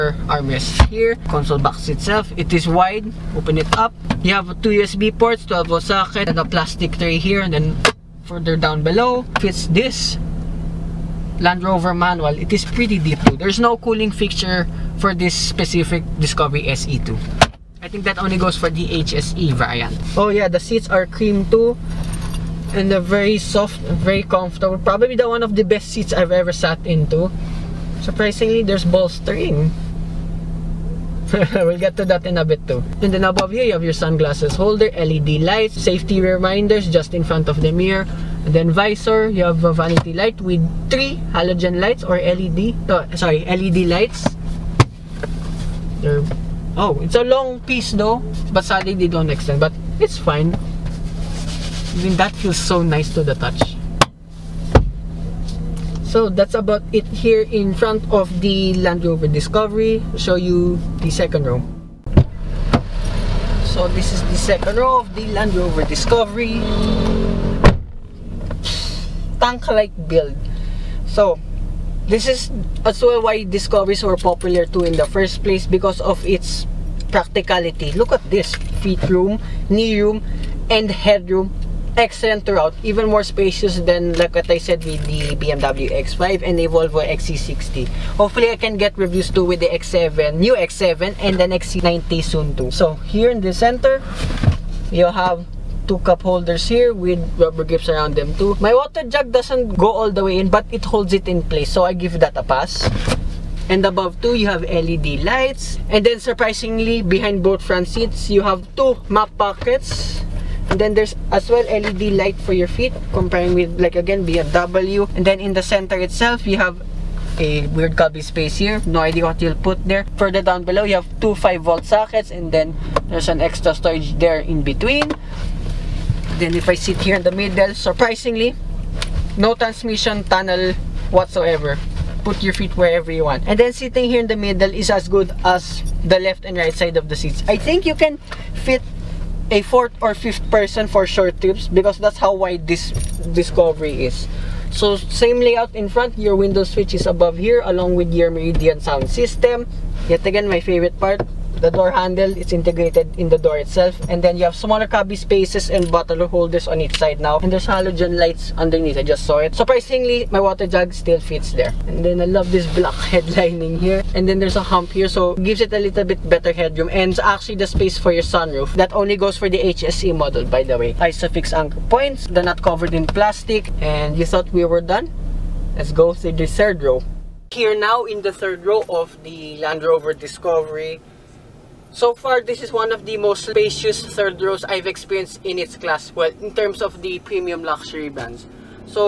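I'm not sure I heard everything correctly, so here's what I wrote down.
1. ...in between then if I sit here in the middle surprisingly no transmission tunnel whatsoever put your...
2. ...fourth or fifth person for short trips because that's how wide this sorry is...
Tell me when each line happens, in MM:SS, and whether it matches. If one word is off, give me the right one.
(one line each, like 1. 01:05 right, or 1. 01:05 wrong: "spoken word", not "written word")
1. 02:04 right
2. 02:19 wrong: "discovery", not "sorry".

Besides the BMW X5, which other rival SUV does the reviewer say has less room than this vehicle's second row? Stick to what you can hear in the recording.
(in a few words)
Volvo XC60.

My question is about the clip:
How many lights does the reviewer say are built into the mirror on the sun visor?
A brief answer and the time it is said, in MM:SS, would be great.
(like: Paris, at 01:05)
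3, at 00:40.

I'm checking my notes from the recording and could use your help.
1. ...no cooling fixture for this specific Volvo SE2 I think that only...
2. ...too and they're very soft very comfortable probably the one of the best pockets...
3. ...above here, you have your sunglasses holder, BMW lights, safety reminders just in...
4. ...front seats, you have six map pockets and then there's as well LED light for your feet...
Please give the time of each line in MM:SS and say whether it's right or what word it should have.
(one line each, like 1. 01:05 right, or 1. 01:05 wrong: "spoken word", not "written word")
1. 00:13 wrong: "Discovery", not "Volvo"
2. 00:21 wrong: "seats", not "pockets"
3. 00:33 wrong: "LED", not "BMW"
4. 01:47 wrong: "two", not "six".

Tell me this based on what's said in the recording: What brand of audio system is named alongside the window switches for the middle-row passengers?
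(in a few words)
Meridian.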